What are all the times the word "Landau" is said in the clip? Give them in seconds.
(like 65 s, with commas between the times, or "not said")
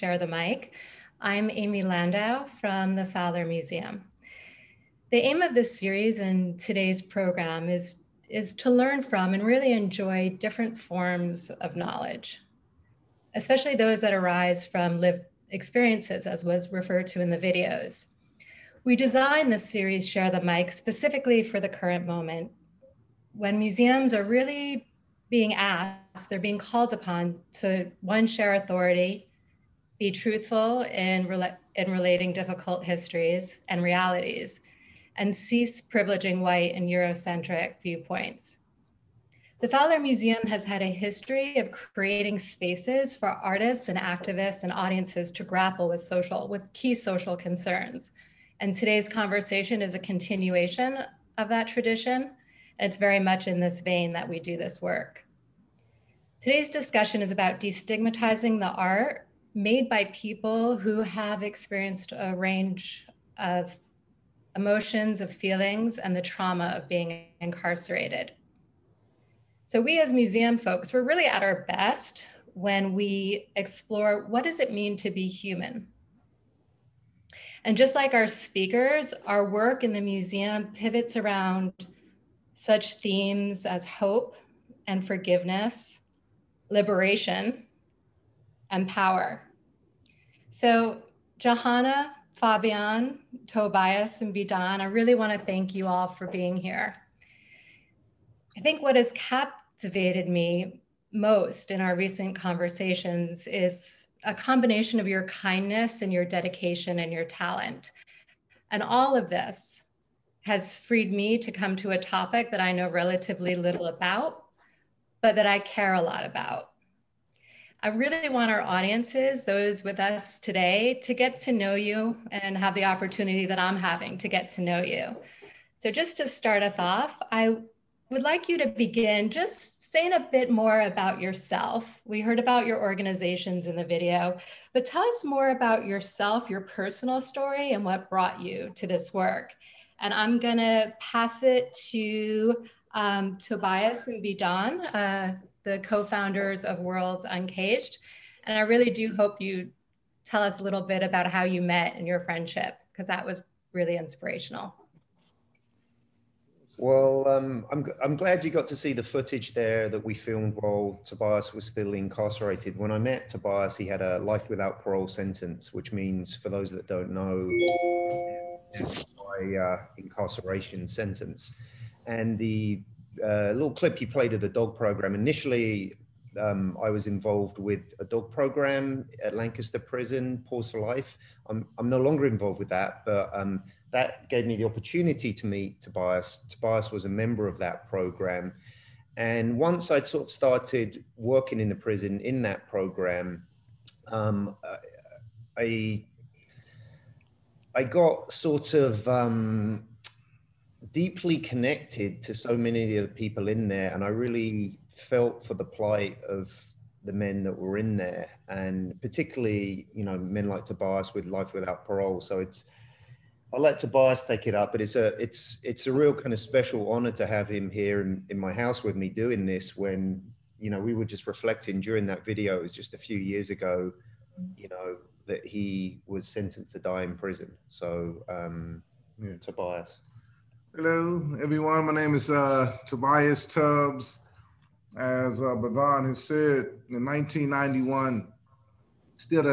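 1 s.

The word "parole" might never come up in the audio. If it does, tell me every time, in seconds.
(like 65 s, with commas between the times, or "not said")
164 s, 211 s.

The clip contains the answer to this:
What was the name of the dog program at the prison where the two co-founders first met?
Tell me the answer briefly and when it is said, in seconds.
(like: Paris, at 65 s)
Paws for Life, at 180 s.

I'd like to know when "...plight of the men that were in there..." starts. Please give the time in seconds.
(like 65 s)
205 s.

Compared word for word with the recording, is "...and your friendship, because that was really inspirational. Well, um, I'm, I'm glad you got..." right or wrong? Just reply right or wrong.
right.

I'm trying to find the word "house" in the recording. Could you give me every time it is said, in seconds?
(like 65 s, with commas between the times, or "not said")
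218 s.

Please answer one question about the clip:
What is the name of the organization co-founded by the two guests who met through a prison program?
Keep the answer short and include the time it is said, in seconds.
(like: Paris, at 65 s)
Words Uncaged, at 146 s.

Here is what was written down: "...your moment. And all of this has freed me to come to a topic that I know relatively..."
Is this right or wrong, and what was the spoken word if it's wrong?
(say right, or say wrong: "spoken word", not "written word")
wrong: "talent", not "moment".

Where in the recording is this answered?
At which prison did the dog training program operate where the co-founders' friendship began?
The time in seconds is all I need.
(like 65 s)
179 s.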